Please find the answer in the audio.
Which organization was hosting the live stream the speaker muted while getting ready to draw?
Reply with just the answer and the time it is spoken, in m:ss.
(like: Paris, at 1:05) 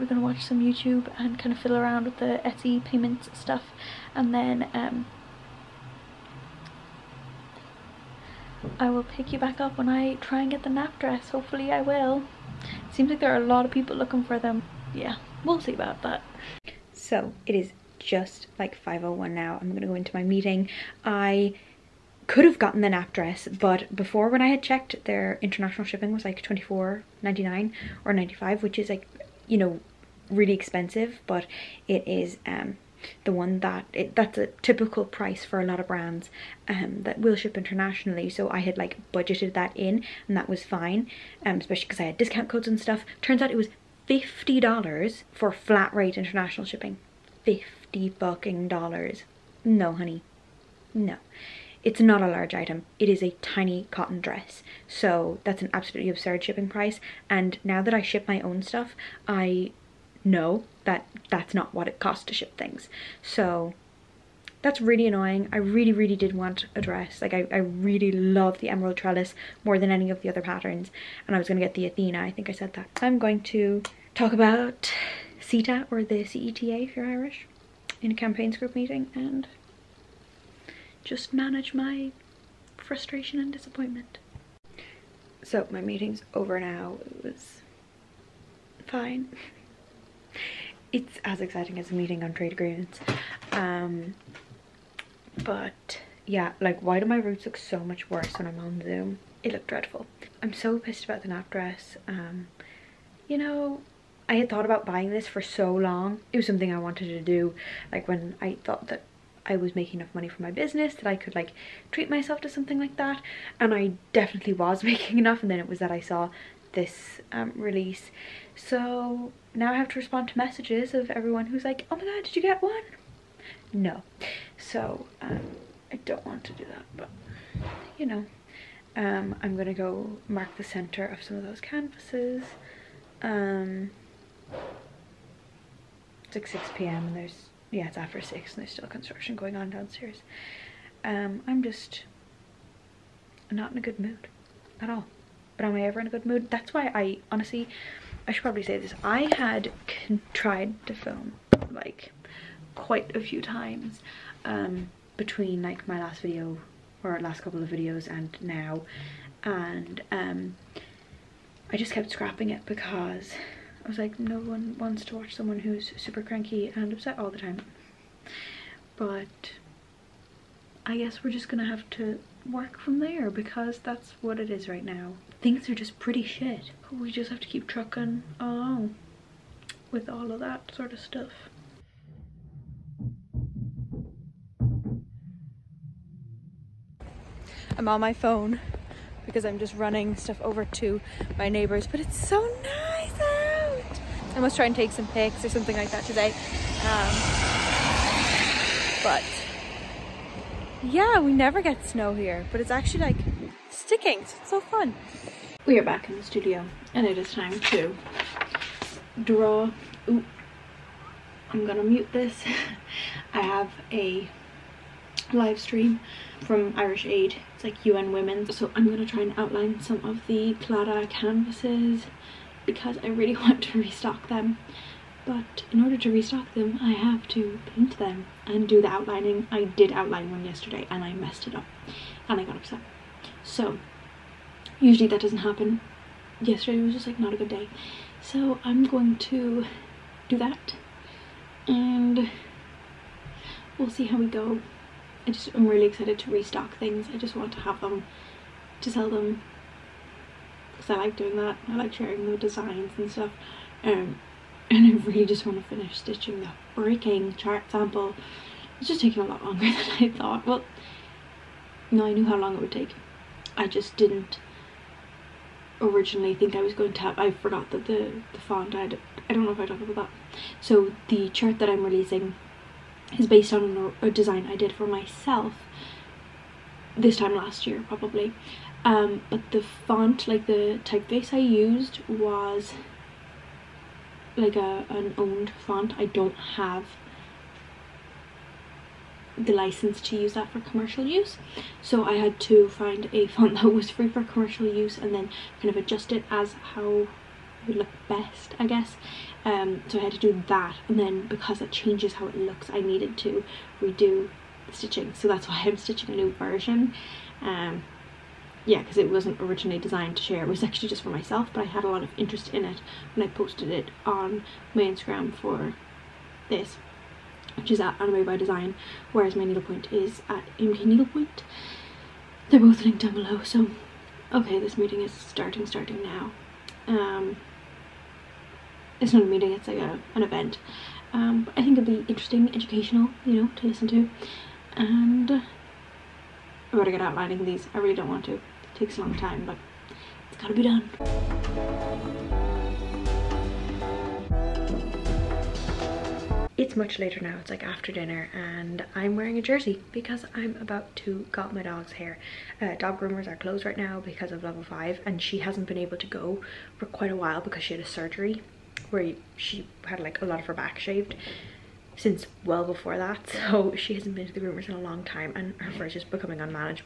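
Irish Aid, at 3:36.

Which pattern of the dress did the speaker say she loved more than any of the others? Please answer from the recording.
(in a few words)
emerald trellis.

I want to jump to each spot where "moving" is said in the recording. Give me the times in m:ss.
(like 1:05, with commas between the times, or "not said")
not said.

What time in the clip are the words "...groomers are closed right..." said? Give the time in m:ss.
5:52.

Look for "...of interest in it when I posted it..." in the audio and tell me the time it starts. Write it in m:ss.
5:12.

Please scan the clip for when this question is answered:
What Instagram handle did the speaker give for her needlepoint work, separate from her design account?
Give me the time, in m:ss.
5:20.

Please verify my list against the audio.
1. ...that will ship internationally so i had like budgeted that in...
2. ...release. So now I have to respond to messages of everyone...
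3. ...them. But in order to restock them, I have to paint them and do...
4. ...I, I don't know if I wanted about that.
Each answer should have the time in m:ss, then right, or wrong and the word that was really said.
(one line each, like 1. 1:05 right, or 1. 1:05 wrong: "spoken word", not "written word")
1. 0:37 right
2. 1:57 right
3. 3:44 right
4. 4:28 wrong: "talked", not "wanted".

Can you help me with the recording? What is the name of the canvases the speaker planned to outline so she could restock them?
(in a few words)
Clara.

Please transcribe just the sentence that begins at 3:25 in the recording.
We are back in the studio and it is time to draw.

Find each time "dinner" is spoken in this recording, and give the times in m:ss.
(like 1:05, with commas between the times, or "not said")
5:47.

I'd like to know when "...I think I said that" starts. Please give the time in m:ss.
1:12.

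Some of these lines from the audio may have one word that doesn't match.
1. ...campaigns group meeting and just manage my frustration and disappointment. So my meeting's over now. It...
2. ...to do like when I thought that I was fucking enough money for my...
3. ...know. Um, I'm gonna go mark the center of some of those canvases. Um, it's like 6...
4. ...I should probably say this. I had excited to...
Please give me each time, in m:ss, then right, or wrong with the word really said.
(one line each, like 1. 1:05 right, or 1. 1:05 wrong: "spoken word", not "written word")
1. 1:18 right
2. 1:47 wrong: "making", not "fucking"
3. 2:08 right
4. 2:28 wrong: "tried", not "excited".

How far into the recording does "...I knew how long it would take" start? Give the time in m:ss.
4:22.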